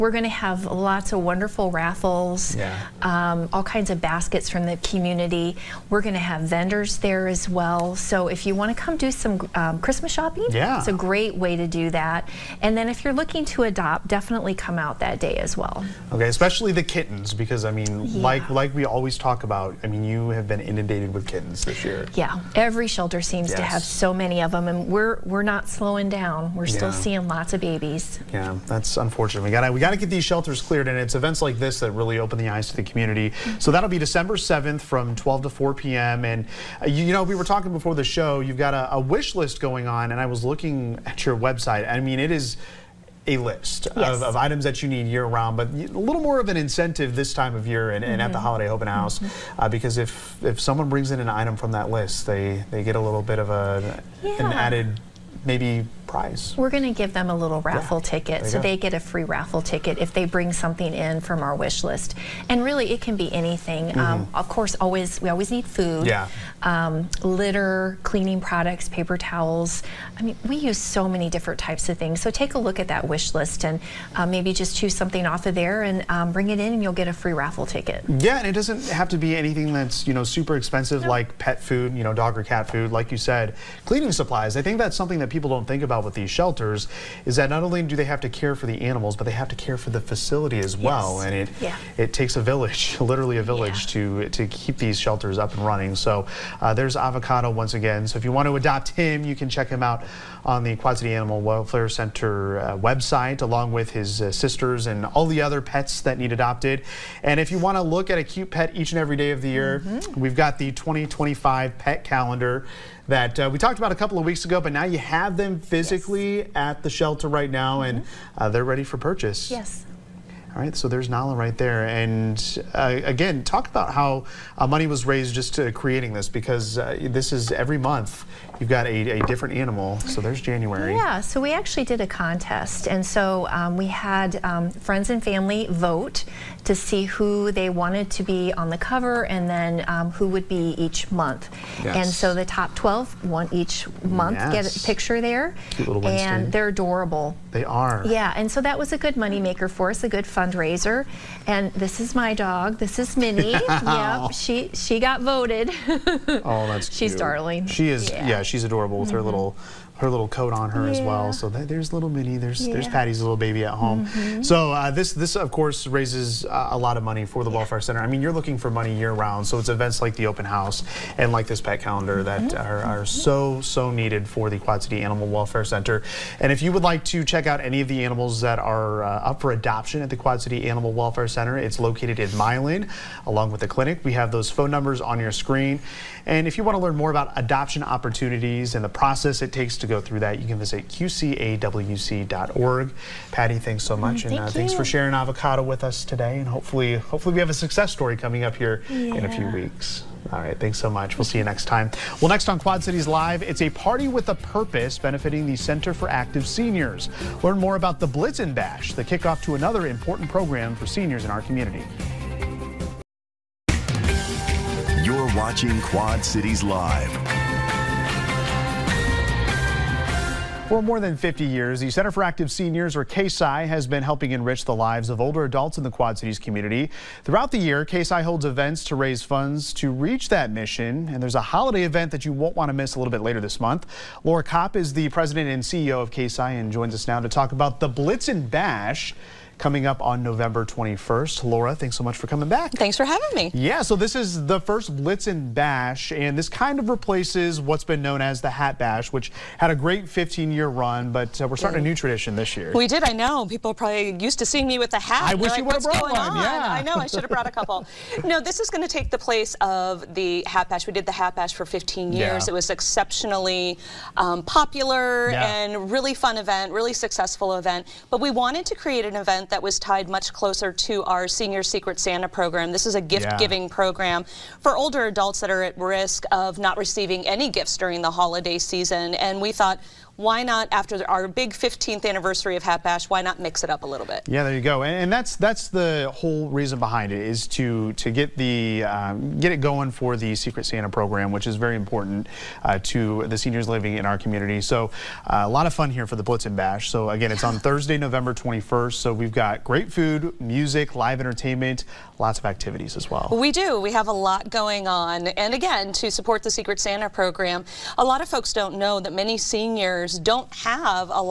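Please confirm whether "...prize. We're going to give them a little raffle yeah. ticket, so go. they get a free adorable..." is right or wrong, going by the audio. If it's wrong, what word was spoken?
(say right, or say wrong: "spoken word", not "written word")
wrong: "raffle", not "adorable".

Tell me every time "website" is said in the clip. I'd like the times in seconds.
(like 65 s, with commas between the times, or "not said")
41 s, 102 s.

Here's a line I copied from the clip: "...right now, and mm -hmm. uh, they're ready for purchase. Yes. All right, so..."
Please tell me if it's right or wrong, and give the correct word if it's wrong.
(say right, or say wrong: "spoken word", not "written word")
right.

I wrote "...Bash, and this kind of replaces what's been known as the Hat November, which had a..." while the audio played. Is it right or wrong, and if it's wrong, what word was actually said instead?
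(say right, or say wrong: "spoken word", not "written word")
wrong: "Bash", not "November".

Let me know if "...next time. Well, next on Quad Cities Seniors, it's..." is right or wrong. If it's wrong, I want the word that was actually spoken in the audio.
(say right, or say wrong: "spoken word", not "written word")
wrong: "Live", not "Seniors".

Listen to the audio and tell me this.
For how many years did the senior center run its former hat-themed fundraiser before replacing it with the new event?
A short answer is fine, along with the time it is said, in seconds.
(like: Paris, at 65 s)
15, at 261 s.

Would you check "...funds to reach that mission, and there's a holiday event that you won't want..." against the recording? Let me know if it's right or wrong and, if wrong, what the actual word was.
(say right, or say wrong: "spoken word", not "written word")
right.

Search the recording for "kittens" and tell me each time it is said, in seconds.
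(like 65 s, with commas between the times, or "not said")
16 s, 21 s.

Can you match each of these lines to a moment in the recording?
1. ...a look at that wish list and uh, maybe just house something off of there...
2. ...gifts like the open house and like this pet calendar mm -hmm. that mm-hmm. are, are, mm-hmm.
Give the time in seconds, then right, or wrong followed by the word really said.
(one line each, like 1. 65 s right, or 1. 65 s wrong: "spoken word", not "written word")
1. 72 s wrong: "choose", not "house"
2. 169 s wrong: "events", not "gifts".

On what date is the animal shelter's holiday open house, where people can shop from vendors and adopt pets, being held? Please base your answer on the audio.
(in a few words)
December 7th.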